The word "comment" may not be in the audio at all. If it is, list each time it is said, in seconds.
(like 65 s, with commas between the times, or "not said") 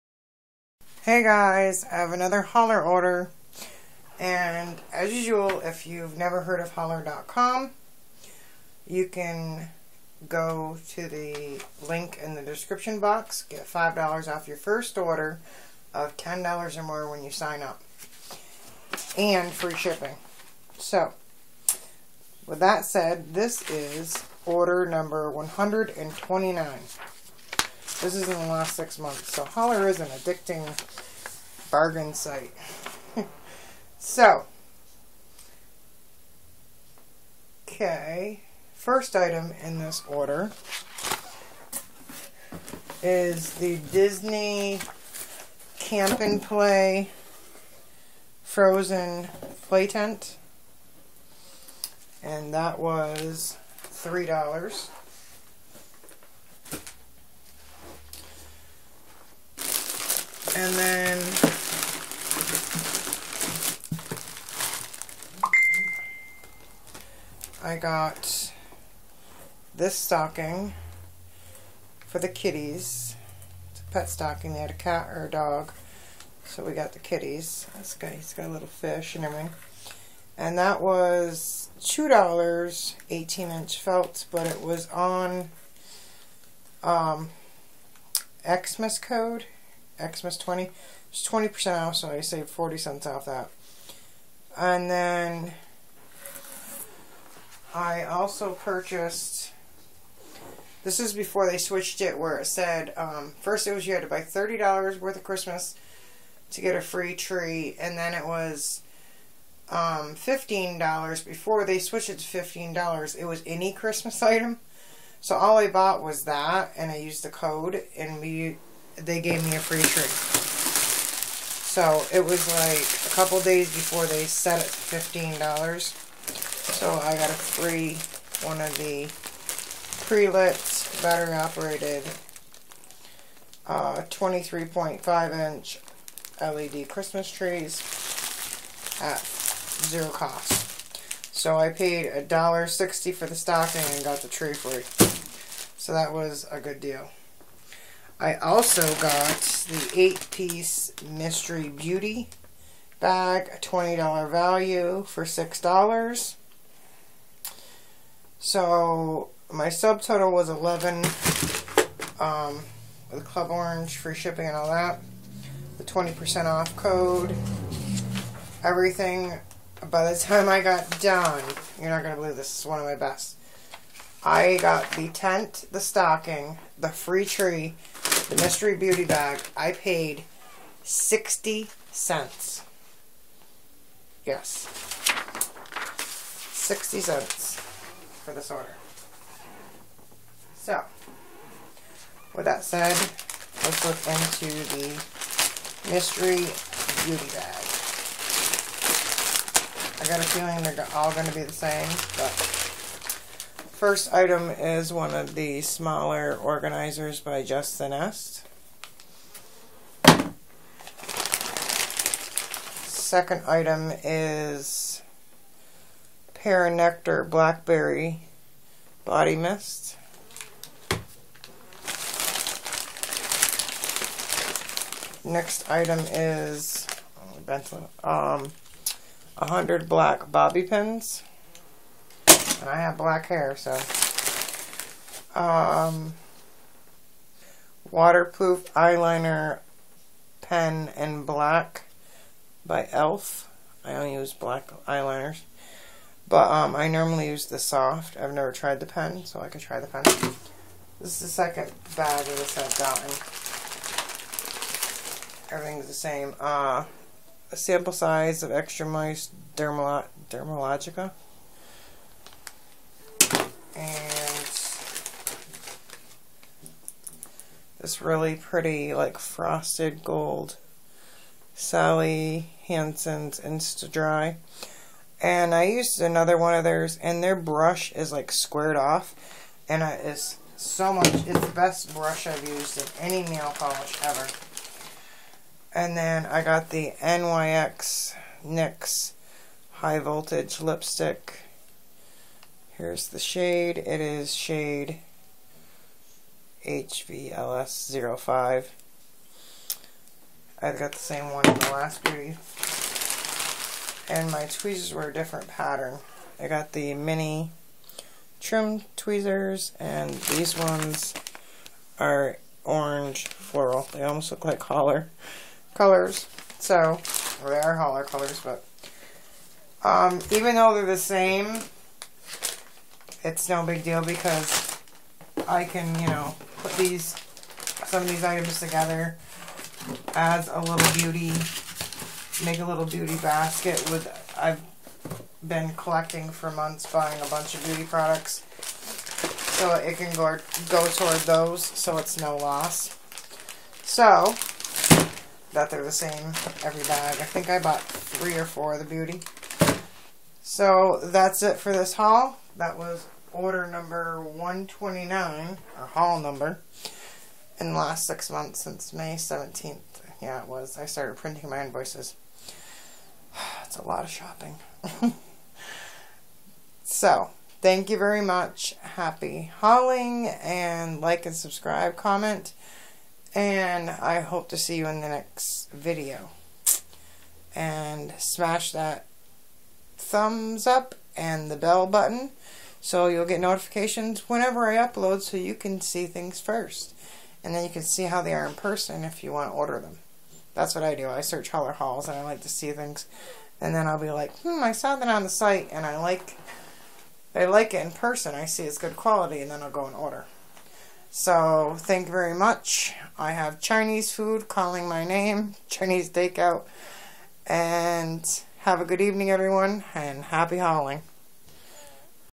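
371 s.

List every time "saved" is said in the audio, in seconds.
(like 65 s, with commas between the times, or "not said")
92 s.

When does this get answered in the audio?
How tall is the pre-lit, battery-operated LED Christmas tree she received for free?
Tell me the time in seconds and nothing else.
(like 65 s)
134 s.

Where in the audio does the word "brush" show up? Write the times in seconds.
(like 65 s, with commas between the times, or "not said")
277 s, 281 s.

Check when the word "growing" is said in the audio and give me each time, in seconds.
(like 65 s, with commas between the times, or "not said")
not said.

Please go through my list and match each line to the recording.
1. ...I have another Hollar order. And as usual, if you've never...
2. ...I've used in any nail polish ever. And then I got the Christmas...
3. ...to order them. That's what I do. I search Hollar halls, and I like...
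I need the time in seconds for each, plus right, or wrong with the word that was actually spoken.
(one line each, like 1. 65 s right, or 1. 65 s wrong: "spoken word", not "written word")
1. 1 s right
2. 282 s wrong: "NYX", not "Christmas"
3. 389 s right.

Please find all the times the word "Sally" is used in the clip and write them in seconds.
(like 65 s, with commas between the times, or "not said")
271 s.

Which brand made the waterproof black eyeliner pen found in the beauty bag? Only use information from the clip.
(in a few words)
e.l.f.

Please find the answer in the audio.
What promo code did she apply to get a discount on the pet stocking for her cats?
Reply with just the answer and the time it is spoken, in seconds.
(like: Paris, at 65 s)
Xmas 20, at 90 s.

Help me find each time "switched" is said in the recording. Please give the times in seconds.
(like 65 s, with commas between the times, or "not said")
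101 s, 111 s.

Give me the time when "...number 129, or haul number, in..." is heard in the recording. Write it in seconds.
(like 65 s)
353 s.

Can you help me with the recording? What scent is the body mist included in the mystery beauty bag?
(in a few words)
Pear Nectar Blackberry.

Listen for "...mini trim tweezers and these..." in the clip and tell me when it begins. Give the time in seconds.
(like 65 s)
306 s.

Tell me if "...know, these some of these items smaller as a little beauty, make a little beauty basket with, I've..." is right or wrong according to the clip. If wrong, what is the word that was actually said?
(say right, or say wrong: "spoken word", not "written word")
wrong: "together", not "smaller".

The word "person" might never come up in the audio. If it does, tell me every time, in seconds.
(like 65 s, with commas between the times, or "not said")
388 s, 397 s.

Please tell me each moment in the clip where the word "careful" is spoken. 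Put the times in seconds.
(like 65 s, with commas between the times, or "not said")
not said.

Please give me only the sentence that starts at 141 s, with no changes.
So I paid a dollar sixty for the stocking and got the tree free.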